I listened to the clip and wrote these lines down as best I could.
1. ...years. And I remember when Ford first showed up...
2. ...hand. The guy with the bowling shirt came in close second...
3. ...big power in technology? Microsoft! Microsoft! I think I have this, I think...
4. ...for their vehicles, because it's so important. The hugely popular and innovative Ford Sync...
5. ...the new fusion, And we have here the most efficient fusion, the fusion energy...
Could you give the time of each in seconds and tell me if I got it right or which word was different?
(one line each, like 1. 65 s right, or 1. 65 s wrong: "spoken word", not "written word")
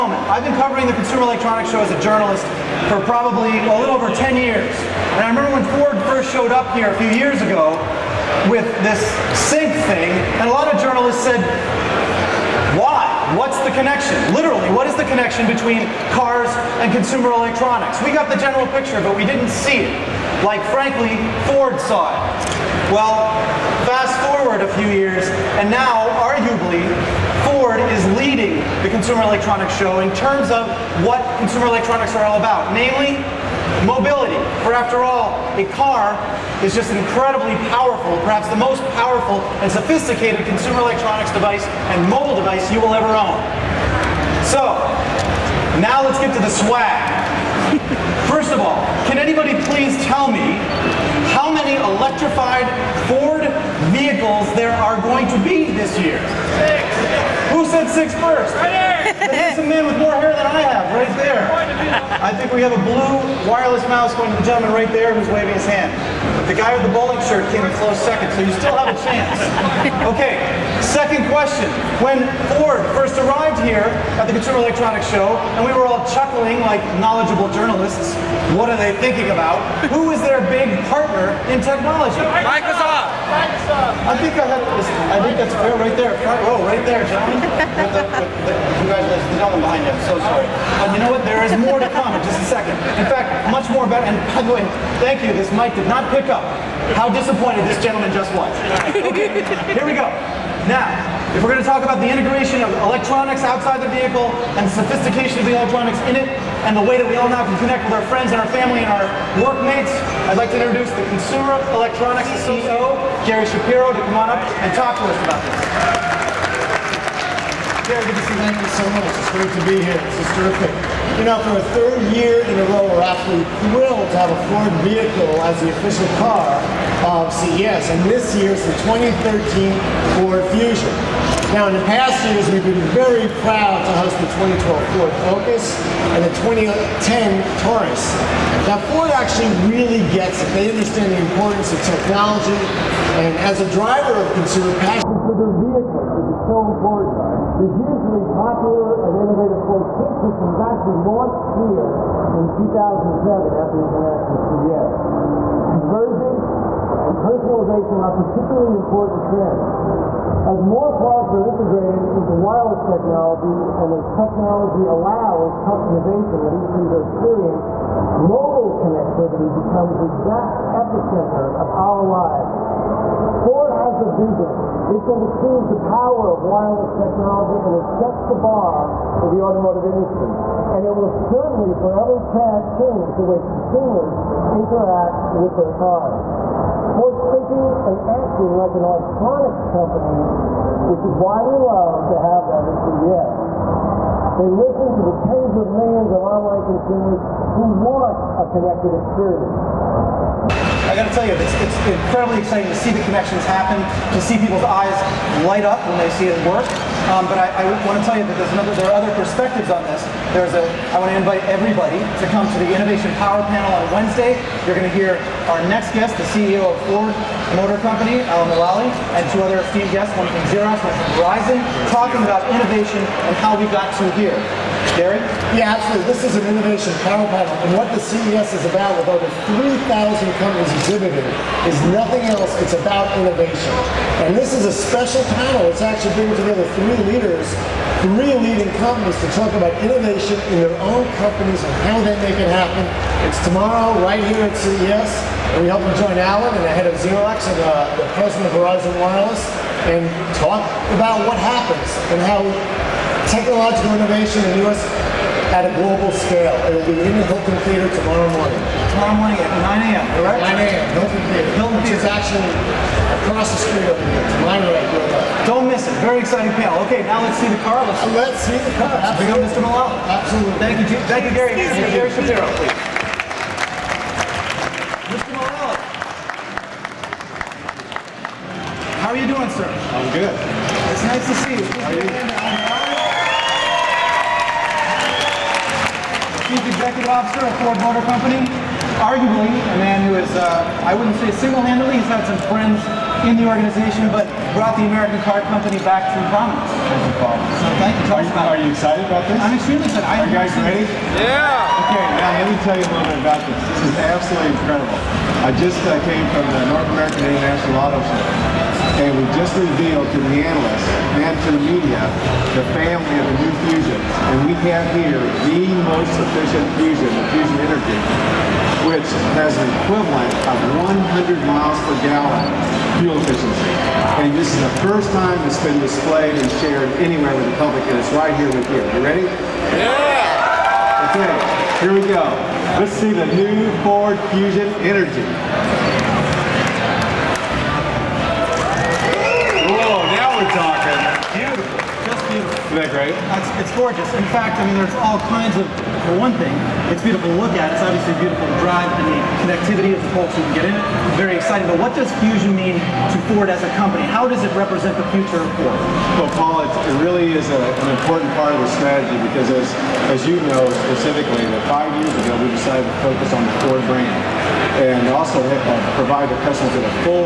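1. 4 s right
2. 65 s right
3. 80 s wrong: "partner", not "power"
4. 145 s right
5. 313 s right.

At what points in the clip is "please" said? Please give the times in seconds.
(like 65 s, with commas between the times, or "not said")
49 s, 272 s.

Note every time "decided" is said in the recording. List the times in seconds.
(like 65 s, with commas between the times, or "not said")
362 s.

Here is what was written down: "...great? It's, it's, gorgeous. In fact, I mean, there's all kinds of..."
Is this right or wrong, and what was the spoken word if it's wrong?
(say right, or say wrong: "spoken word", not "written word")
right.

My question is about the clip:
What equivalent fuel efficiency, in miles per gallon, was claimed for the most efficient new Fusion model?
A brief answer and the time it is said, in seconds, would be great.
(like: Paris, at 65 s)
100 miles per gallon, at 320 s.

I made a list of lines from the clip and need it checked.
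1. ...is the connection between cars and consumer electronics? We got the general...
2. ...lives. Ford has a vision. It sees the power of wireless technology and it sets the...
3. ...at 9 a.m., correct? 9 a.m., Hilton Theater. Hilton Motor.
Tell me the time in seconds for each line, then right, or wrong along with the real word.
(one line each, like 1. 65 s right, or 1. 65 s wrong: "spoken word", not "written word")
1. 14 s right
2. 172 s right
3. 259 s wrong: "Theater", not "Motor".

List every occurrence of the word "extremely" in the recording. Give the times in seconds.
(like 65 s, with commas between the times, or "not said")
299 s.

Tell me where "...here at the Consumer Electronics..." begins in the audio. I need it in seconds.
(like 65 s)
73 s.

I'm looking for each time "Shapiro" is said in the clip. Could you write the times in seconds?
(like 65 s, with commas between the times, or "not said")
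113 s, 272 s.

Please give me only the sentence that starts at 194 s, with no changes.
They listen to the tens of millions of online consumers who want a connected experience.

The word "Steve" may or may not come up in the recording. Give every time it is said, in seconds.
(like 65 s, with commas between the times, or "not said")
not said.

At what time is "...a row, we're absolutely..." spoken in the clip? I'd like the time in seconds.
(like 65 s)
122 s.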